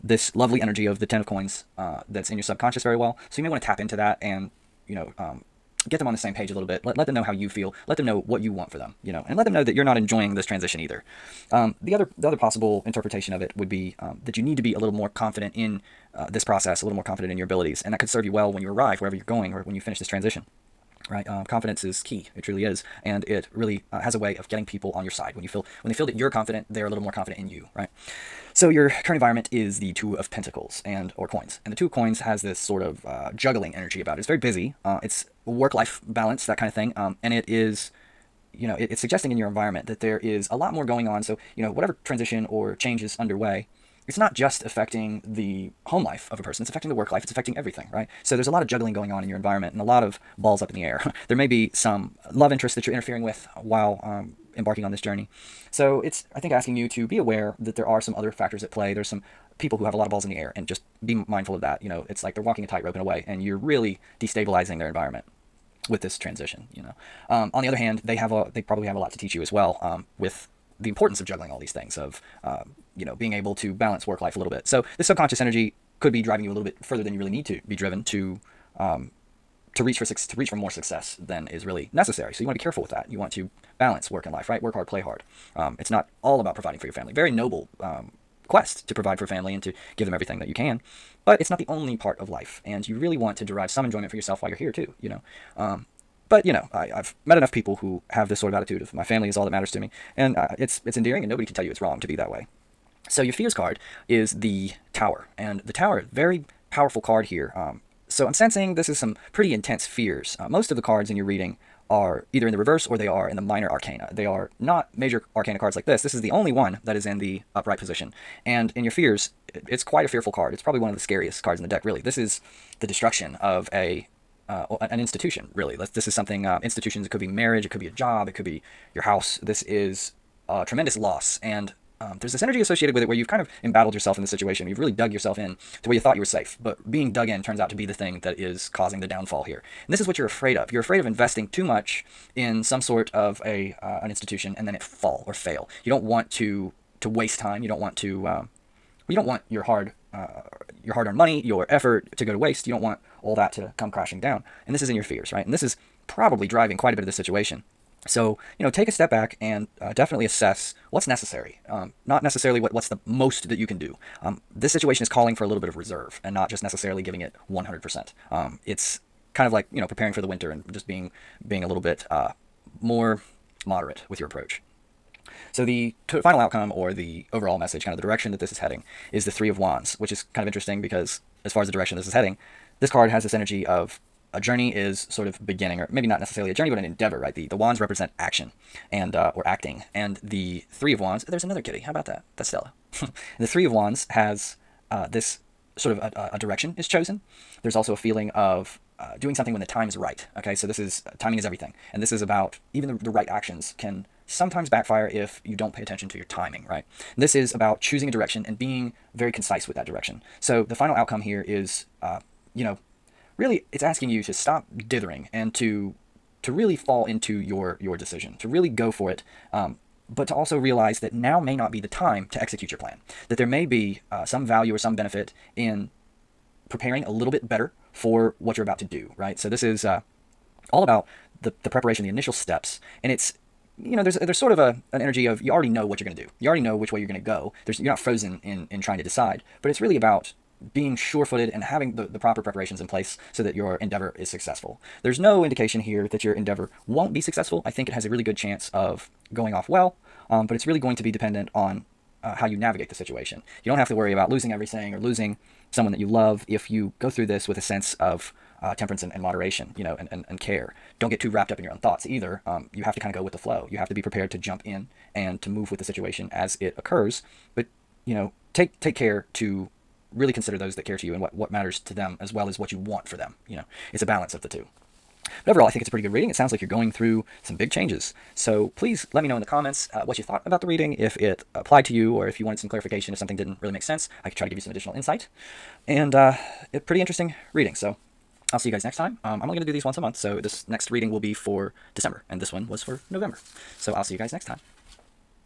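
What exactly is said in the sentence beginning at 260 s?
Don't get too wrapped up in your own thoughts either.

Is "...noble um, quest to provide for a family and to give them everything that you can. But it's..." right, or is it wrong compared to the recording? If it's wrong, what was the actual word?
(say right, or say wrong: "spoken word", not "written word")
right.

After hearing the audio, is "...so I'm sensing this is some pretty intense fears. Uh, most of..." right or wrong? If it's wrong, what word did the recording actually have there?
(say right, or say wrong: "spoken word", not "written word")
right.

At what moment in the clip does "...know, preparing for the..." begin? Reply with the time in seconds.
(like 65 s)
169 s.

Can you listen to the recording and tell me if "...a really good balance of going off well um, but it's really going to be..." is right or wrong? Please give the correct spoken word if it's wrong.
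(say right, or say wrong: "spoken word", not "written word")
wrong: "chance", not "balance".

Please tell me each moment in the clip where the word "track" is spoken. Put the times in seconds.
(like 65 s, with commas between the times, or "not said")
not said.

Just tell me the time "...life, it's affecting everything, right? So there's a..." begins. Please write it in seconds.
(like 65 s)
47 s.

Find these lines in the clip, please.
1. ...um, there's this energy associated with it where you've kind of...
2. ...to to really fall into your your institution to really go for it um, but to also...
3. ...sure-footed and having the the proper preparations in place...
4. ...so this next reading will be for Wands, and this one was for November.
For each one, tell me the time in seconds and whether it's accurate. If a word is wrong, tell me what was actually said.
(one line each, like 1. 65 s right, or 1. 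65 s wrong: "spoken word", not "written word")
1. 132 s right
2. 215 s wrong: "decision", not "institution"
3. 240 s right
4. 290 s wrong: "December", not "Wands".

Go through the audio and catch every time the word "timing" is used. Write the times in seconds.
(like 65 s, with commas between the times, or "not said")
201 s, 206 s.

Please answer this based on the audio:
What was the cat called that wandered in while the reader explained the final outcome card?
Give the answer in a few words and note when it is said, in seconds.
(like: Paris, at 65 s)
Stella, at 192 s.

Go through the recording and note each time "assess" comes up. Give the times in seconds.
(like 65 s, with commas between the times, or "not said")
160 s.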